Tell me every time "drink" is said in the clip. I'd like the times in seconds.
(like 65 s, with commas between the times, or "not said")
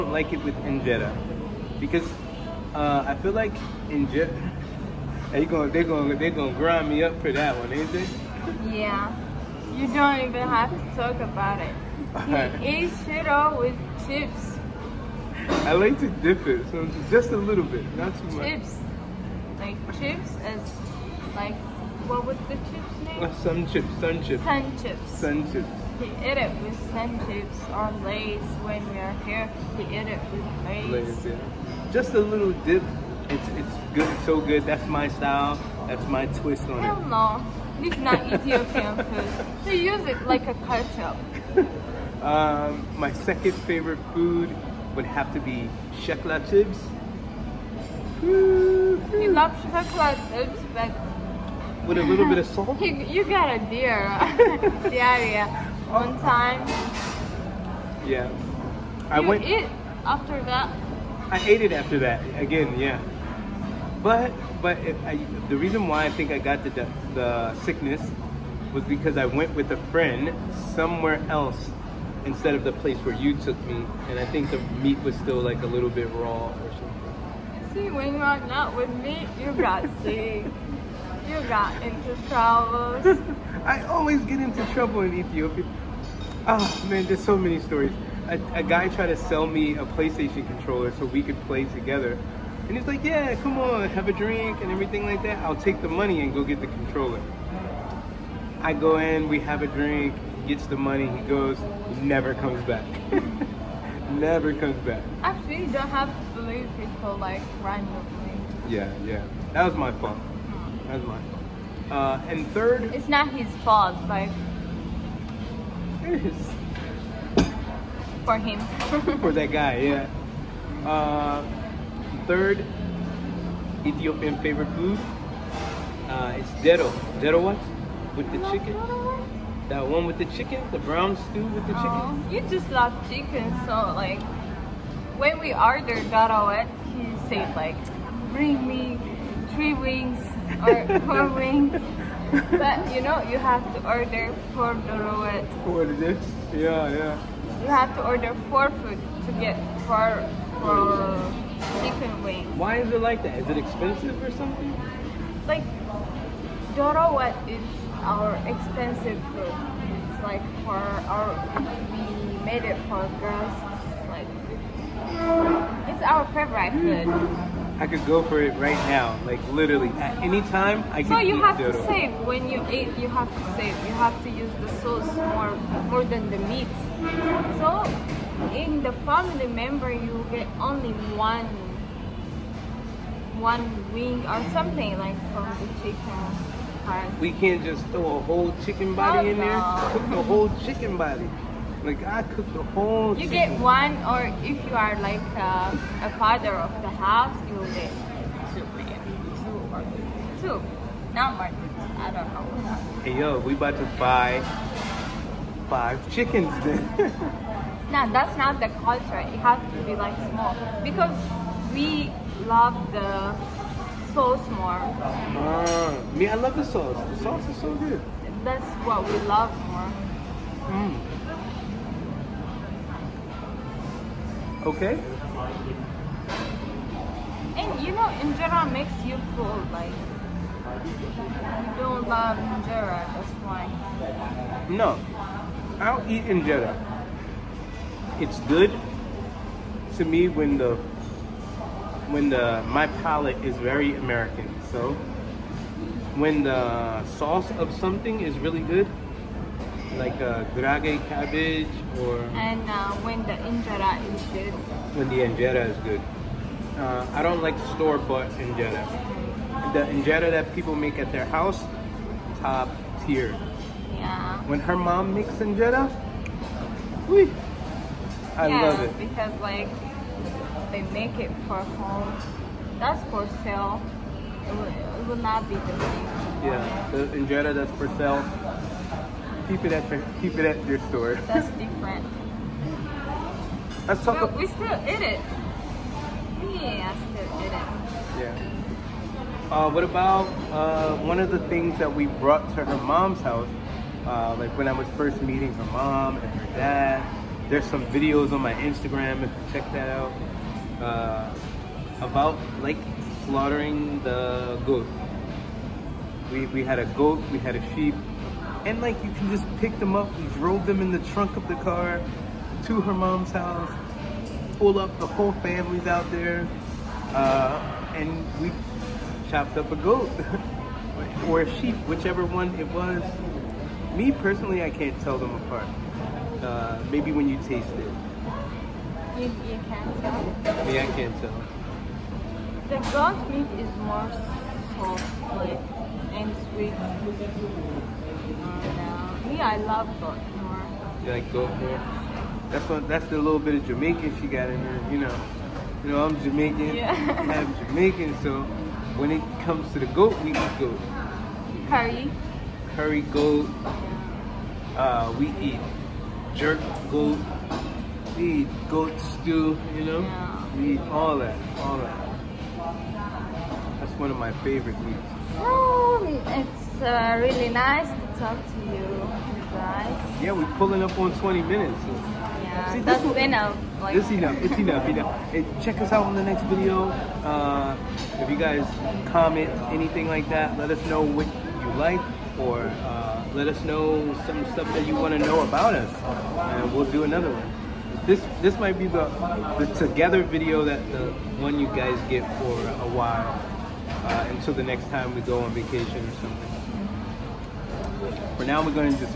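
94 s, 99 s.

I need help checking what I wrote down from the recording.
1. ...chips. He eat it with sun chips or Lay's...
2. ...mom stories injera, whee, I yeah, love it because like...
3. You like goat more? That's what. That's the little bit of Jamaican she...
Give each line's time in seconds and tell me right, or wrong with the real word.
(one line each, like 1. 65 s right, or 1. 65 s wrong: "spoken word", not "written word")
1. 25 s right
2. 264 s wrong: "makes", not "stories"
3. 341 s right.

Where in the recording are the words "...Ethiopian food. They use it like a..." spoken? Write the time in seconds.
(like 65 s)
38 s.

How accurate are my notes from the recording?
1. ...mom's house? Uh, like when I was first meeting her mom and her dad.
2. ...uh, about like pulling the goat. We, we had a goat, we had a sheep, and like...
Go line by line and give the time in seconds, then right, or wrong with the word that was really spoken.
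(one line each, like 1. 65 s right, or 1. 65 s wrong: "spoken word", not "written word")
1. 292 s right
2. 300 s wrong: "slaughtering", not "pulling".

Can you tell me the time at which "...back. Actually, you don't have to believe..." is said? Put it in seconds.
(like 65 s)
104 s.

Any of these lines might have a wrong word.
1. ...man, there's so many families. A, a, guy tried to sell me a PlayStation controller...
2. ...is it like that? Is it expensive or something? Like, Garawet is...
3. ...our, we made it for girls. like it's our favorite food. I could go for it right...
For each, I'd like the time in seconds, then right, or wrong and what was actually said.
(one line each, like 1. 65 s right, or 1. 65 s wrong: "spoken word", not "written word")
1. 86 s wrong: "stories", not "families"
2. 152 s right
3. 160 s right.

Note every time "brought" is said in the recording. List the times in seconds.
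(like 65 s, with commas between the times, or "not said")
292 s.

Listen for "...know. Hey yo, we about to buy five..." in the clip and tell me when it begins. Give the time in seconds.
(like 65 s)
202 s.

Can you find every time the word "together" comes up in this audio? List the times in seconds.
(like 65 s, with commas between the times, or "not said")
91 s, 389 s.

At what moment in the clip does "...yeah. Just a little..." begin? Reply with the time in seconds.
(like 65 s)
31 s.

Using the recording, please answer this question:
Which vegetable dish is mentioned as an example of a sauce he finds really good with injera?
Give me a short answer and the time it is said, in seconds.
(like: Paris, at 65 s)
cabbage, at 251 s.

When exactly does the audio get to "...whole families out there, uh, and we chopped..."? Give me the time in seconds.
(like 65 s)
315 s.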